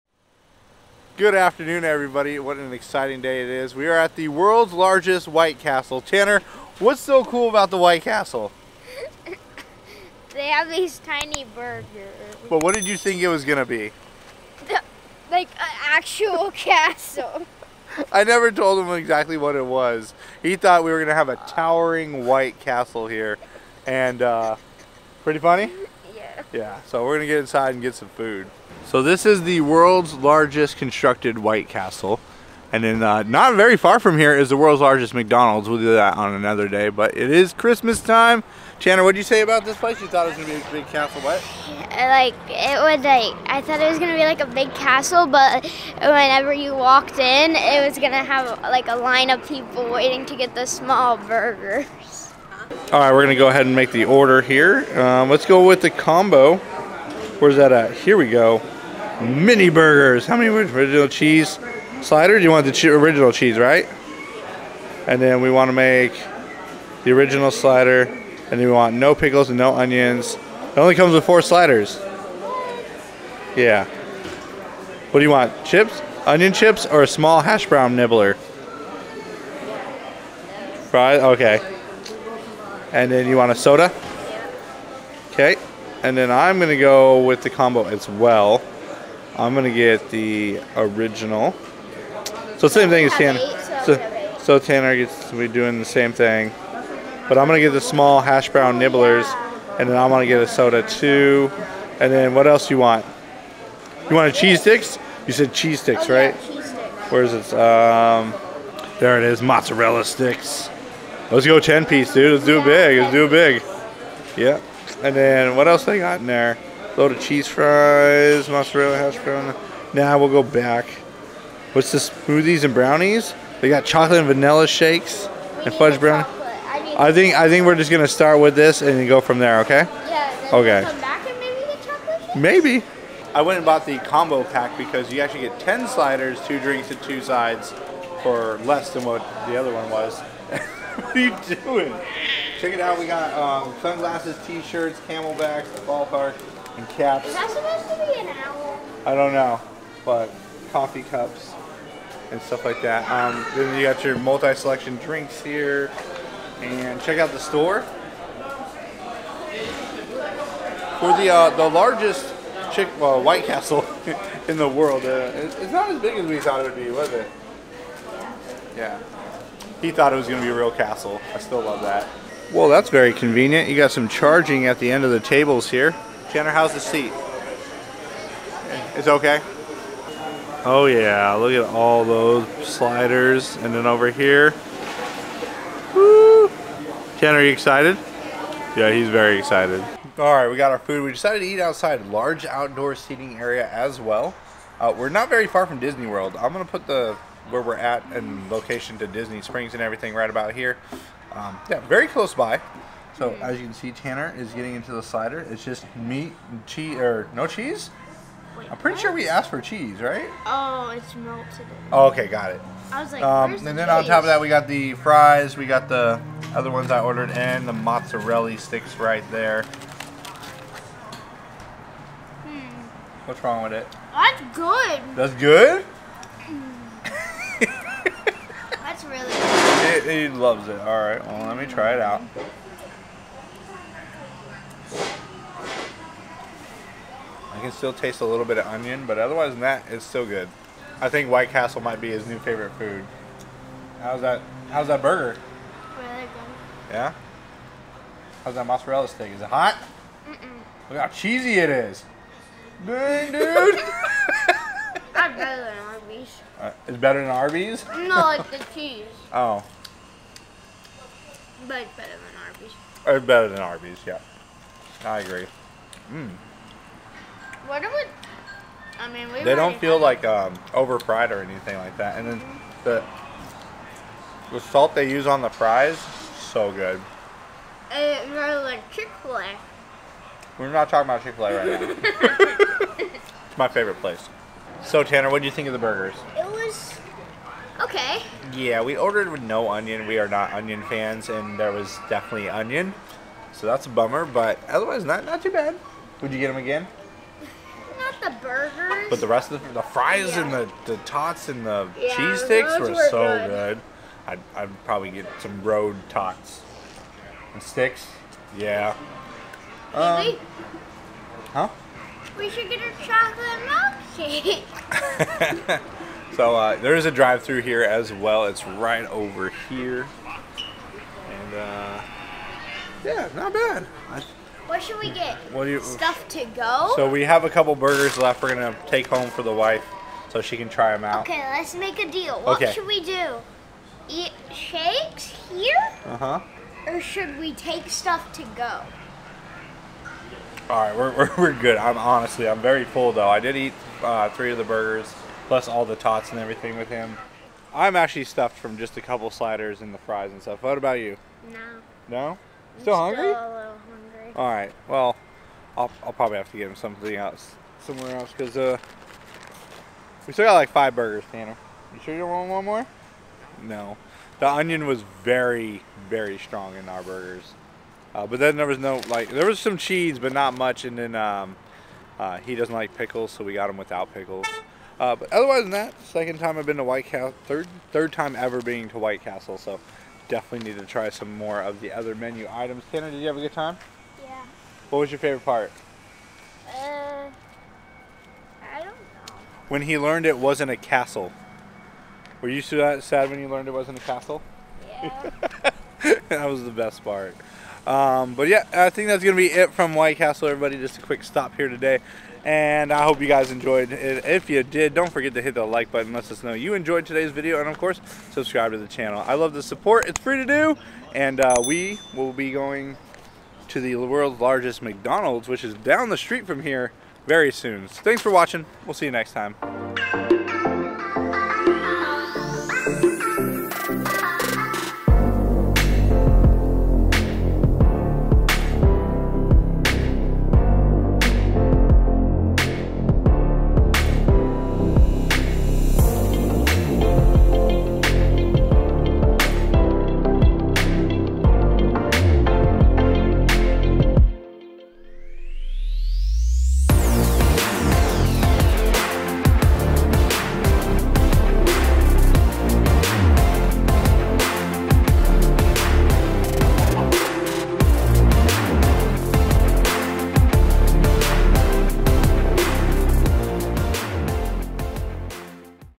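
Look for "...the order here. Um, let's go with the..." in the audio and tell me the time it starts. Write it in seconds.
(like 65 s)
53 s.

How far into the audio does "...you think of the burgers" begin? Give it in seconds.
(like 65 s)
285 s.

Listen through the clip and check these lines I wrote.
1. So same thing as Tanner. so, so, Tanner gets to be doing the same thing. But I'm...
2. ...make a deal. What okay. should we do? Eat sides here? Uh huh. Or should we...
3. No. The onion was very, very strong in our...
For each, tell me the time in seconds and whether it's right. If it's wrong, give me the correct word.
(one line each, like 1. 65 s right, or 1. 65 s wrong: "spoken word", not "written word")
1. 92 s right
2. 331 s wrong: "shakes", not "sides"
3. 363 s right.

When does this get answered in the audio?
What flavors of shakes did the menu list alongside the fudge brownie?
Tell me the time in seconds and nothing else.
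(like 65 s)
123 s.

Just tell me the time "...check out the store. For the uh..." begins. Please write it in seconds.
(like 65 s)
157 s.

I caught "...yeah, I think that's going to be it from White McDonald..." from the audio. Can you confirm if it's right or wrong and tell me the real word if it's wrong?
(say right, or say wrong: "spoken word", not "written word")
wrong: "Castle", not "McDonald".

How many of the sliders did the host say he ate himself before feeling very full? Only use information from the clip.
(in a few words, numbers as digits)
3.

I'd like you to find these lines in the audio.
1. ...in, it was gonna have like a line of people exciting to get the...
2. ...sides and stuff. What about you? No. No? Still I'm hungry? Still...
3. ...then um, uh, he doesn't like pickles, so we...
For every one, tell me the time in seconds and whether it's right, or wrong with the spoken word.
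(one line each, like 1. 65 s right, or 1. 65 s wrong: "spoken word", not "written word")
1. 47 s wrong: "waiting", not "exciting"
2. 349 s wrong: "fries", not "sides"
3. 370 s right.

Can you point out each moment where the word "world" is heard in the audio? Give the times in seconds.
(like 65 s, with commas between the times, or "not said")
4 s, 29 s, 34 s, 164 s, 196 s, 413 s.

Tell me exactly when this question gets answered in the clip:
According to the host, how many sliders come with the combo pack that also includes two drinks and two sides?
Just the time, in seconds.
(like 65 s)
135 s.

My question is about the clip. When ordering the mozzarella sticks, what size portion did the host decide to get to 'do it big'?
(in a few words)
10 piece.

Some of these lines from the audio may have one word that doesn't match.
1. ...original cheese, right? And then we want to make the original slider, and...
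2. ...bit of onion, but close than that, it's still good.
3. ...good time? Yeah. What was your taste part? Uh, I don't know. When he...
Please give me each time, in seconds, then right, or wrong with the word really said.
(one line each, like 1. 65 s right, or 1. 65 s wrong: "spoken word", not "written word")
1. 62 s right
2. 238 s wrong: "otherwise", not "close"
3. 383 s wrong: "favorite", not "taste".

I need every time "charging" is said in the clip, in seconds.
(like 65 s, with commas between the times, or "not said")
174 s.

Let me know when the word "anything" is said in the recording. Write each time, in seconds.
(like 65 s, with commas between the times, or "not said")
271 s.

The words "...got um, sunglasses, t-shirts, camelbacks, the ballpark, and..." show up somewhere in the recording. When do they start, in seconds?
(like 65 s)
143 s.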